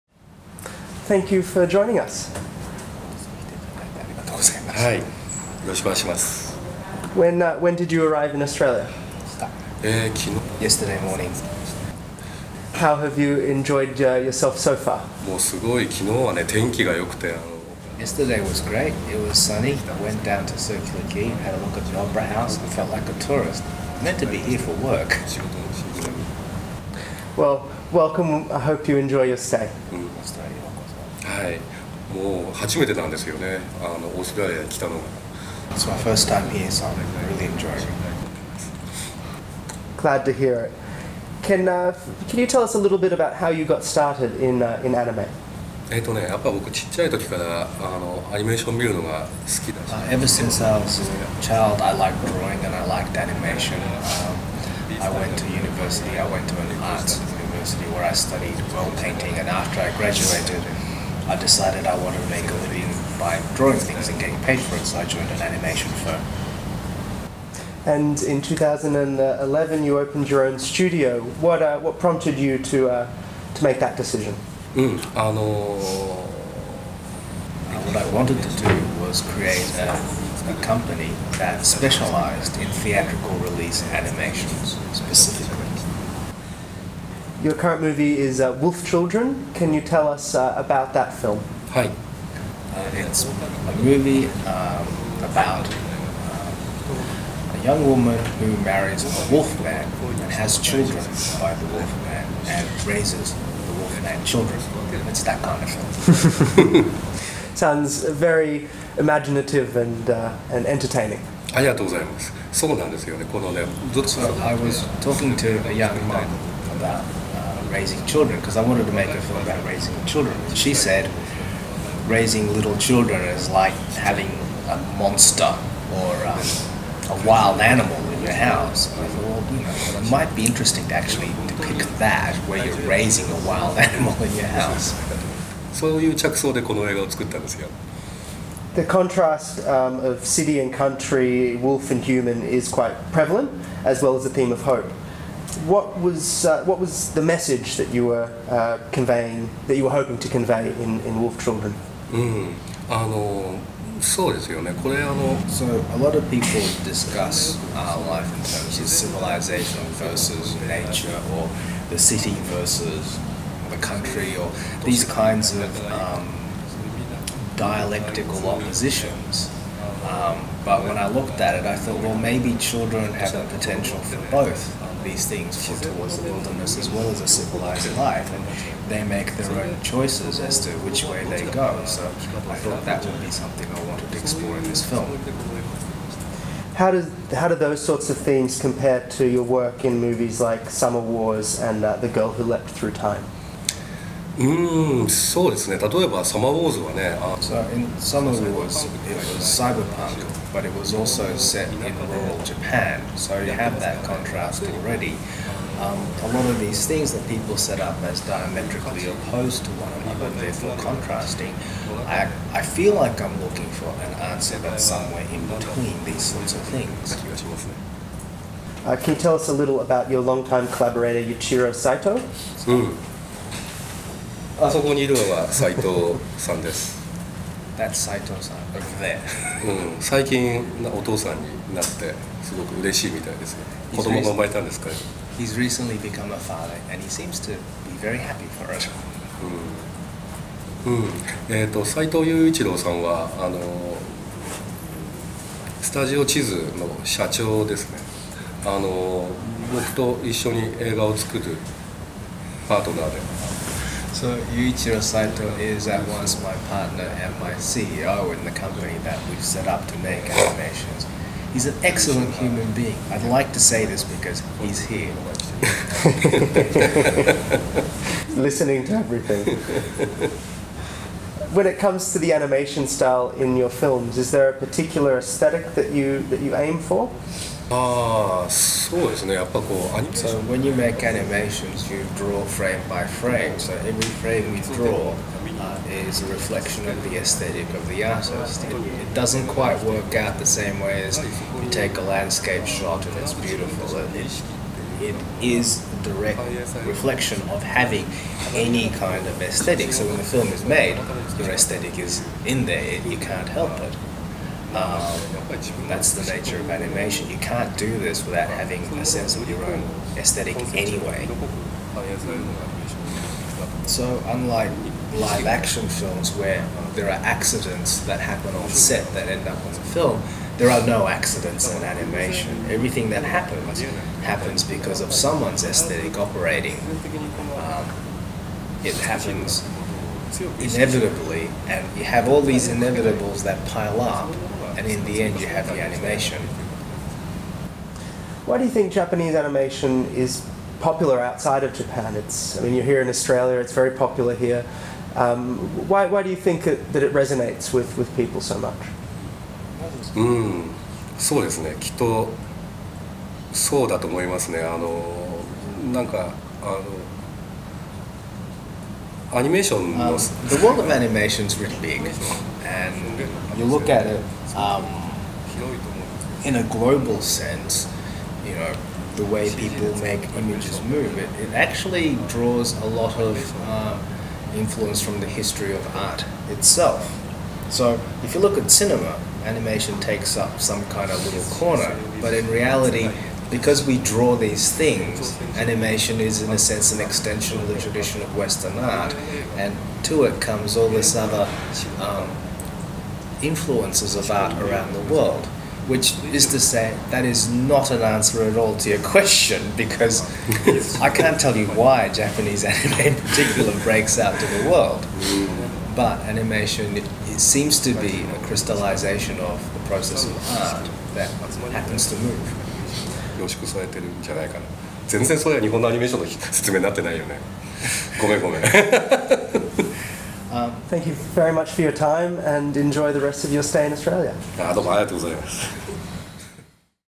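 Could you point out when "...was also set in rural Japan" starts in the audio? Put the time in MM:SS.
03:20.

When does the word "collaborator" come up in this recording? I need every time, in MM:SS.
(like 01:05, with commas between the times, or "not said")
03:40.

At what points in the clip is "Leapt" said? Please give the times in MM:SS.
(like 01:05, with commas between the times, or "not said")
03:12.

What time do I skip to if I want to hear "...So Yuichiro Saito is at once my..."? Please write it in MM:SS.
04:14.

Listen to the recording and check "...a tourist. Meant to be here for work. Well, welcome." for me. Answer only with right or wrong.
right.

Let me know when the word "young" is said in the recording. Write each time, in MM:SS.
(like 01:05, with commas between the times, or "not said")
01:37, 01:55.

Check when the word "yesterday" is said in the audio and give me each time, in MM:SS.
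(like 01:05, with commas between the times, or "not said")
00:10, 00:17.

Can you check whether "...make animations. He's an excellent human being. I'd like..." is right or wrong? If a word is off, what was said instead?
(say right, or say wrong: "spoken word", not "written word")
right.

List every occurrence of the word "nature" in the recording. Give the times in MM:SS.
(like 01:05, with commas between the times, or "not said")
02:40, 05:06.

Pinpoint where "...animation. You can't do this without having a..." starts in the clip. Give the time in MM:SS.
05:06.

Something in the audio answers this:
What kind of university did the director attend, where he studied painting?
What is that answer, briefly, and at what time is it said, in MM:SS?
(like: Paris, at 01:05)
An arts university, at 00:56.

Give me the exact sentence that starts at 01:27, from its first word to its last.
Your current movie is uh, Wolf Children.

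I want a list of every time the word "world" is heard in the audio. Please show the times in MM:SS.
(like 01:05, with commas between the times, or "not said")
06:00, 06:35, 06:44.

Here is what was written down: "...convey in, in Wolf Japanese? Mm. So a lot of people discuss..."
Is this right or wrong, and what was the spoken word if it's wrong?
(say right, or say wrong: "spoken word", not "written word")
wrong: "Children", not "Japanese".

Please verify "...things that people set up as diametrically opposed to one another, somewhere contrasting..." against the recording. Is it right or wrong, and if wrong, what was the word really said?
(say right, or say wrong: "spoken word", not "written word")
wrong: "therefore", not "somewhere".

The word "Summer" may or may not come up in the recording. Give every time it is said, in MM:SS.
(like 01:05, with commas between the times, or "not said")
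03:10, 03:15.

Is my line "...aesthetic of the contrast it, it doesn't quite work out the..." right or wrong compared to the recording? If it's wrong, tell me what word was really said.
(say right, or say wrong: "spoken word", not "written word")
wrong: "artist", not "contrast".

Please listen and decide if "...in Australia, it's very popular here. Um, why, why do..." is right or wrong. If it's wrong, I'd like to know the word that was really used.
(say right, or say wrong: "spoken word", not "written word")
right.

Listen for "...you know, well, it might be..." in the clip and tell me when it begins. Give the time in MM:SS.
02:09.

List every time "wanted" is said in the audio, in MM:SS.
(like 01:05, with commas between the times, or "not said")
01:02, 01:18, 01:58, 03:03.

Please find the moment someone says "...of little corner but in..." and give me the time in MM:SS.
06:21.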